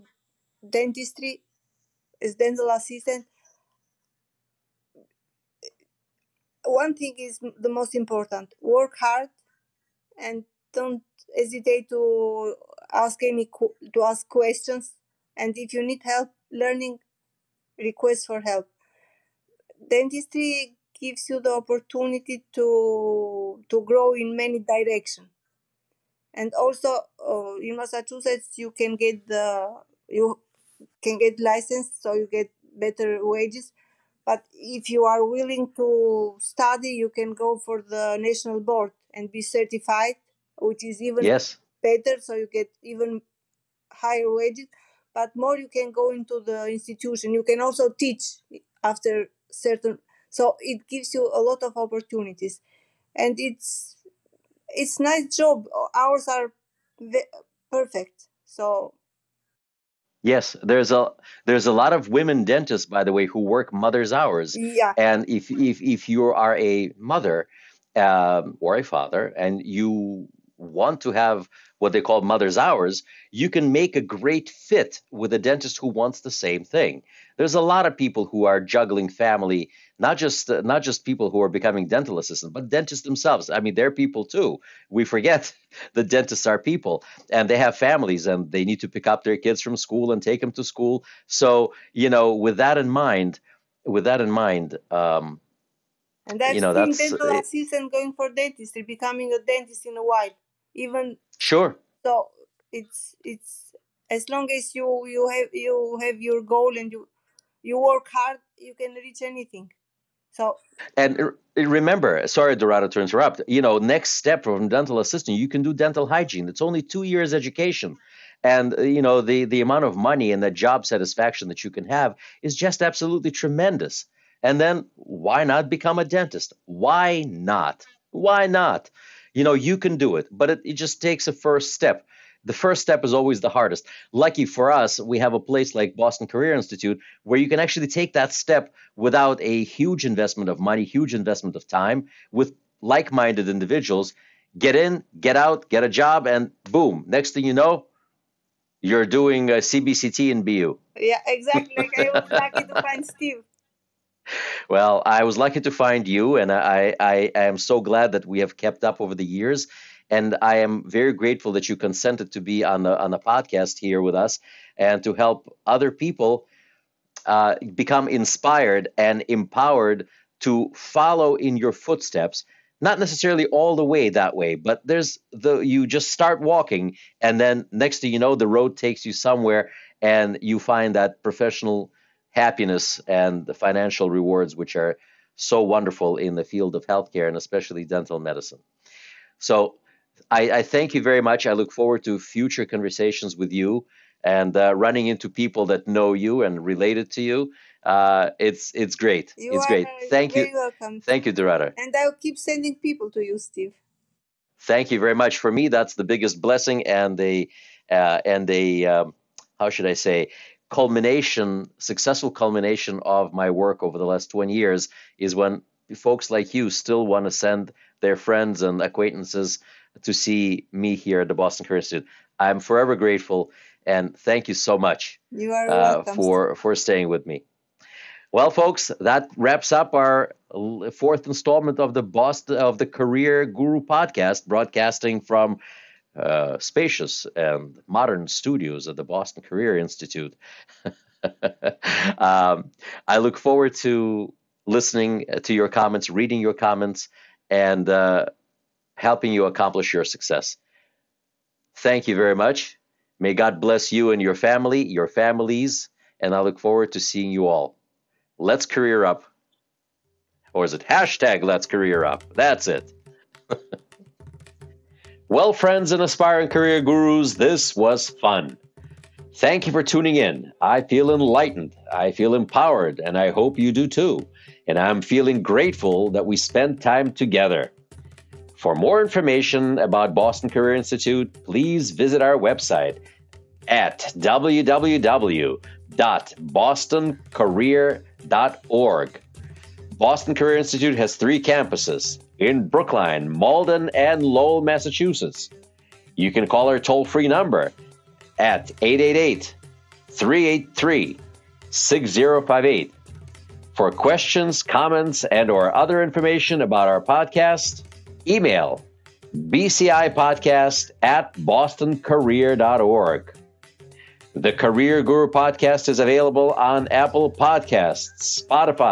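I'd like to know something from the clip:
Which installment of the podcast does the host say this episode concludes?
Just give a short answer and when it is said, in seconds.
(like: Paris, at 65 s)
fourth, at 230 s.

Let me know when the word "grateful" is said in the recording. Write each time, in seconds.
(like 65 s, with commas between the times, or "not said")
161 s, 222 s, 275 s.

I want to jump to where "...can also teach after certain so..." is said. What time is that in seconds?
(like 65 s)
47 s.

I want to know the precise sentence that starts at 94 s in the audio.
Um, and that's you know, being that's, uh, dental it, assistant going for dentistry, becoming a dentist in a while, even sure.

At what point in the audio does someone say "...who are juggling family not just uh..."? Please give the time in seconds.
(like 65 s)
78 s.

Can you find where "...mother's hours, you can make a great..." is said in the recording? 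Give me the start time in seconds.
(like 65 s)
72 s.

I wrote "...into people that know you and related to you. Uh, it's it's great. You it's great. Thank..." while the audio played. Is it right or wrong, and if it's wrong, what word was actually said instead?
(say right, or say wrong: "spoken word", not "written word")
right.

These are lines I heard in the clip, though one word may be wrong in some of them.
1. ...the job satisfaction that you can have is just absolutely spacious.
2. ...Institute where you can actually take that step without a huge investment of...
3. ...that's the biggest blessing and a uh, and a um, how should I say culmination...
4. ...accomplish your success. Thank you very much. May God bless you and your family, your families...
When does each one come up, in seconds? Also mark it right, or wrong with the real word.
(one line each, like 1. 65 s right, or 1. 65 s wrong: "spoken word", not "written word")
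1. 120 s wrong: "tremendous", not "spacious"
2. 136 s right
3. 205 s right
4. 249 s right.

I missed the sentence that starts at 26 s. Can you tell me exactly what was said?
And also uh, in Massachusetts, you can get the you can get license, so you get better wages.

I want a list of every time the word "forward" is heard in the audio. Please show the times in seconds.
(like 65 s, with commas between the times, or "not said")
191 s, 243 s, 256 s.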